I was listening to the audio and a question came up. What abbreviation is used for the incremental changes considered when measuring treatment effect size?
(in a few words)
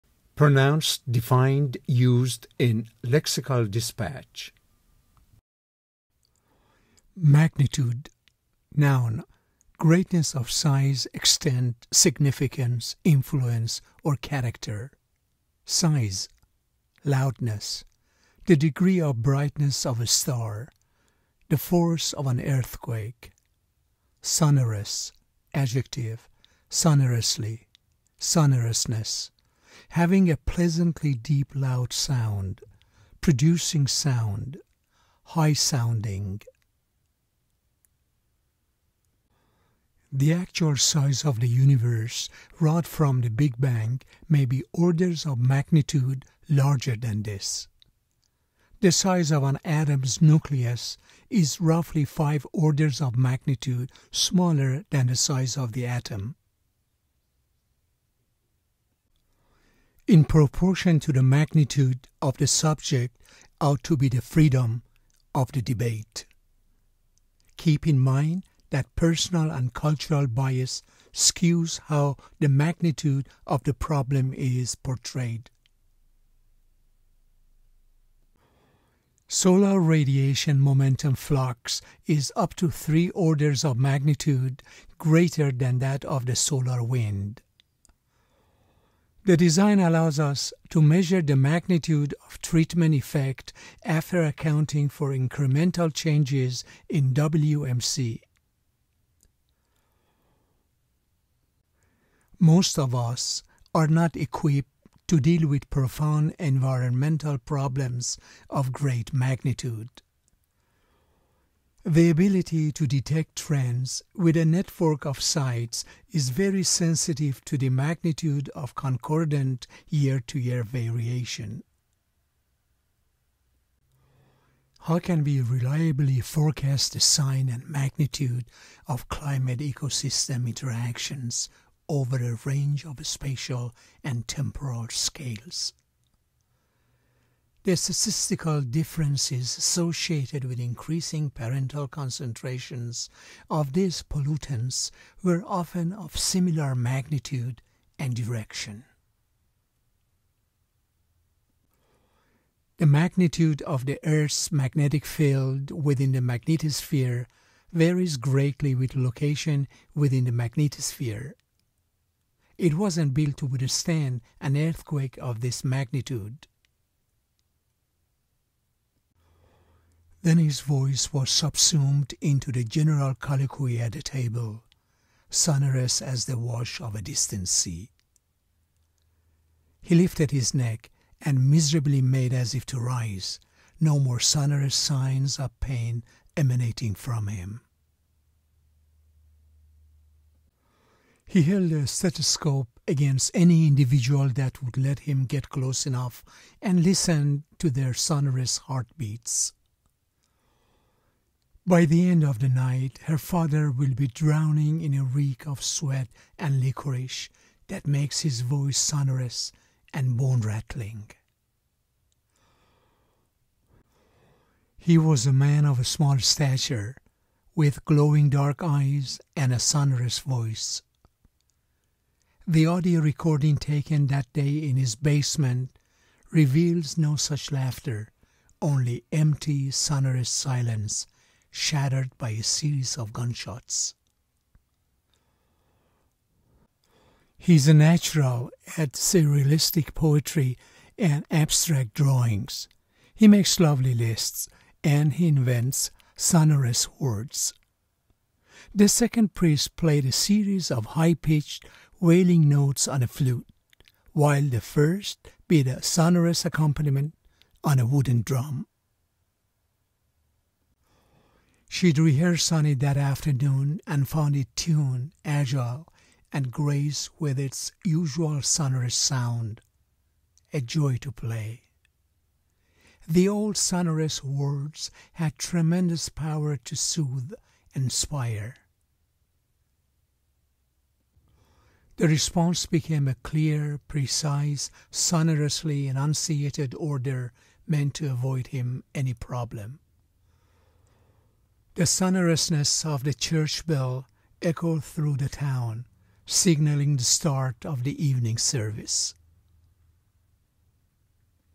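WMC.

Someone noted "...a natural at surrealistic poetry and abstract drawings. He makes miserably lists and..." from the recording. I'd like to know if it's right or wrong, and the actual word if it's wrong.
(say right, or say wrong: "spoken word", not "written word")
wrong: "lovely", not "miserably".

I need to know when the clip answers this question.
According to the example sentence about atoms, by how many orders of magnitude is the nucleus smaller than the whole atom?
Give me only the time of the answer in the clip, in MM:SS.
00:52.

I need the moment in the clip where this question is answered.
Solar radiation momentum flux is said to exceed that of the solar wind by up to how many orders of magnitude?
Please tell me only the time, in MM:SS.
01:22.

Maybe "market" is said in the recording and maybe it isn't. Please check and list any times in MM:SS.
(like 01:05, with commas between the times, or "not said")
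not said.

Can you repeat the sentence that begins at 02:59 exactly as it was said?
He lifted his neck and miserably made as if to rise, no more sonorous signs of pain emanating from him.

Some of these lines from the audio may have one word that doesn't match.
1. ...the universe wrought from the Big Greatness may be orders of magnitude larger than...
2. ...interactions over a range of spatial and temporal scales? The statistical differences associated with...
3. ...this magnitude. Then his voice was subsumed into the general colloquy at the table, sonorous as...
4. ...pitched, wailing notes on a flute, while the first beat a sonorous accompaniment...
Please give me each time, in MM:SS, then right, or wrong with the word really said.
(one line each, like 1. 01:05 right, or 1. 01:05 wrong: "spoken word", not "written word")
1. 00:41 wrong: "Bang", not "Greatness"
2. 02:10 right
3. 02:45 right
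4. 04:11 right.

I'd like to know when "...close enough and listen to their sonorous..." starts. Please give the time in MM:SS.
03:15.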